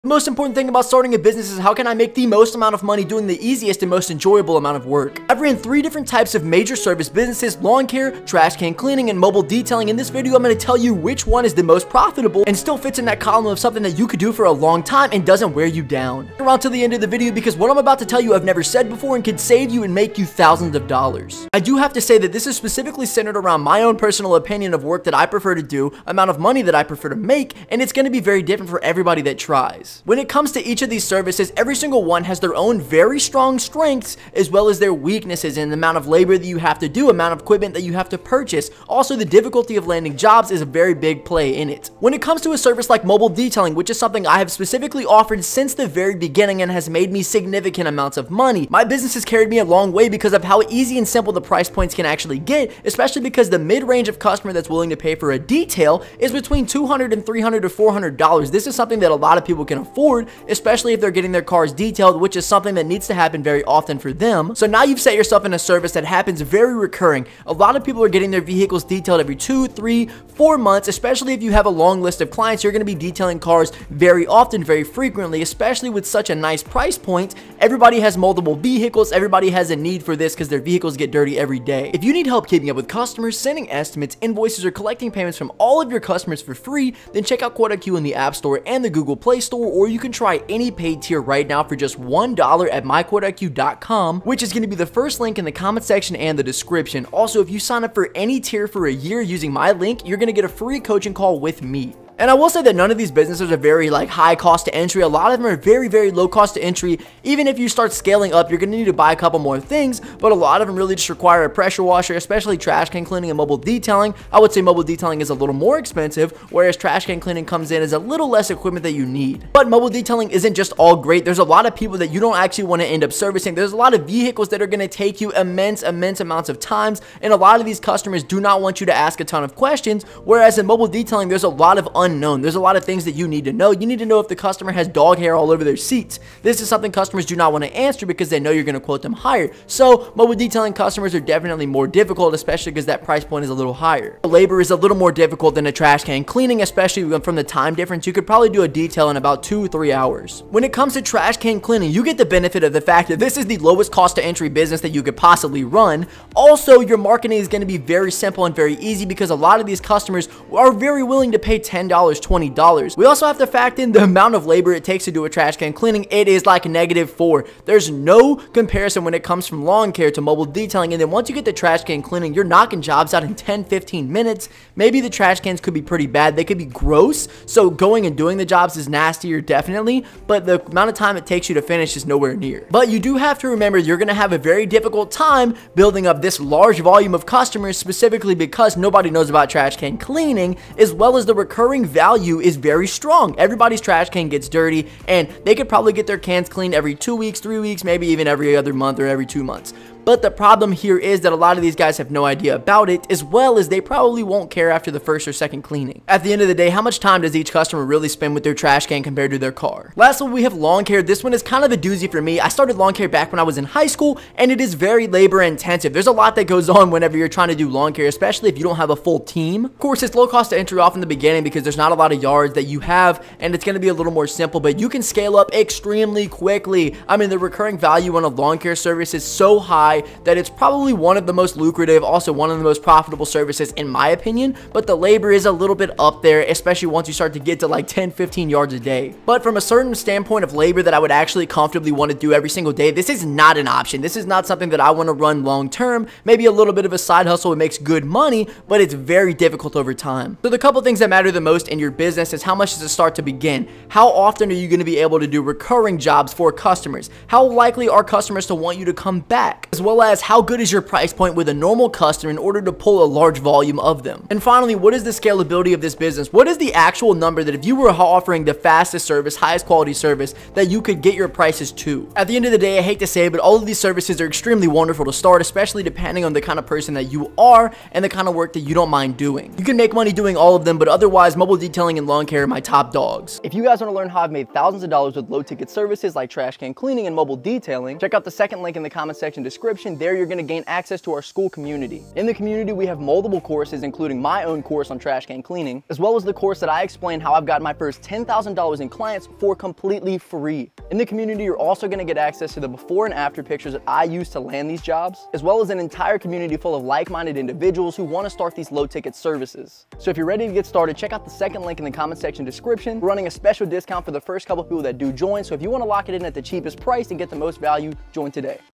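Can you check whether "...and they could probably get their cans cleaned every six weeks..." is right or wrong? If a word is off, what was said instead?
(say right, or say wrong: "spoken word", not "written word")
wrong: "two", not "six".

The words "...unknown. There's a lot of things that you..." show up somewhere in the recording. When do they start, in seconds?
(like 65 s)
132 s.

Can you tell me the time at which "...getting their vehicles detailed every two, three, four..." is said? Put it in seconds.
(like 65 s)
68 s.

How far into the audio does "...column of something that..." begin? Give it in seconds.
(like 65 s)
13 s.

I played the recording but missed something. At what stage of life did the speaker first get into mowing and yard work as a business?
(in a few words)
high school.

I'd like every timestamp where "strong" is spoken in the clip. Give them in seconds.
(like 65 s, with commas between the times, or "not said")
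33 s, 192 s.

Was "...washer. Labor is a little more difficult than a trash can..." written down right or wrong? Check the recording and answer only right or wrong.
wrong.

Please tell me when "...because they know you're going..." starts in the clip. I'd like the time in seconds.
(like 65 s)
138 s.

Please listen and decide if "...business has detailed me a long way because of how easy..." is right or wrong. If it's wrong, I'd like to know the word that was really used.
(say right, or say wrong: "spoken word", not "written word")
wrong: "carried", not "detailed".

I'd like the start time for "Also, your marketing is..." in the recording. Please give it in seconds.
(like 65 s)
156 s.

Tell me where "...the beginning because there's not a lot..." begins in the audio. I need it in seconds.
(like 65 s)
221 s.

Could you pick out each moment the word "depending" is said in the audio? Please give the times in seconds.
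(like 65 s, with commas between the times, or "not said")
275 s.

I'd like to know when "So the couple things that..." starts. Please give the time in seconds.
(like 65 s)
250 s.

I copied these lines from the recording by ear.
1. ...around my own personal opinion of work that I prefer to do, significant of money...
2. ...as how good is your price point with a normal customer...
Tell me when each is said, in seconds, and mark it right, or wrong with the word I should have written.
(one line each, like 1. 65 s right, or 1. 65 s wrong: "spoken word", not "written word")
1. 23 s wrong: "amount", not "significant"
2. 260 s right.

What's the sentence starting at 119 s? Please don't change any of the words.
But mobile detailing isn't just all great.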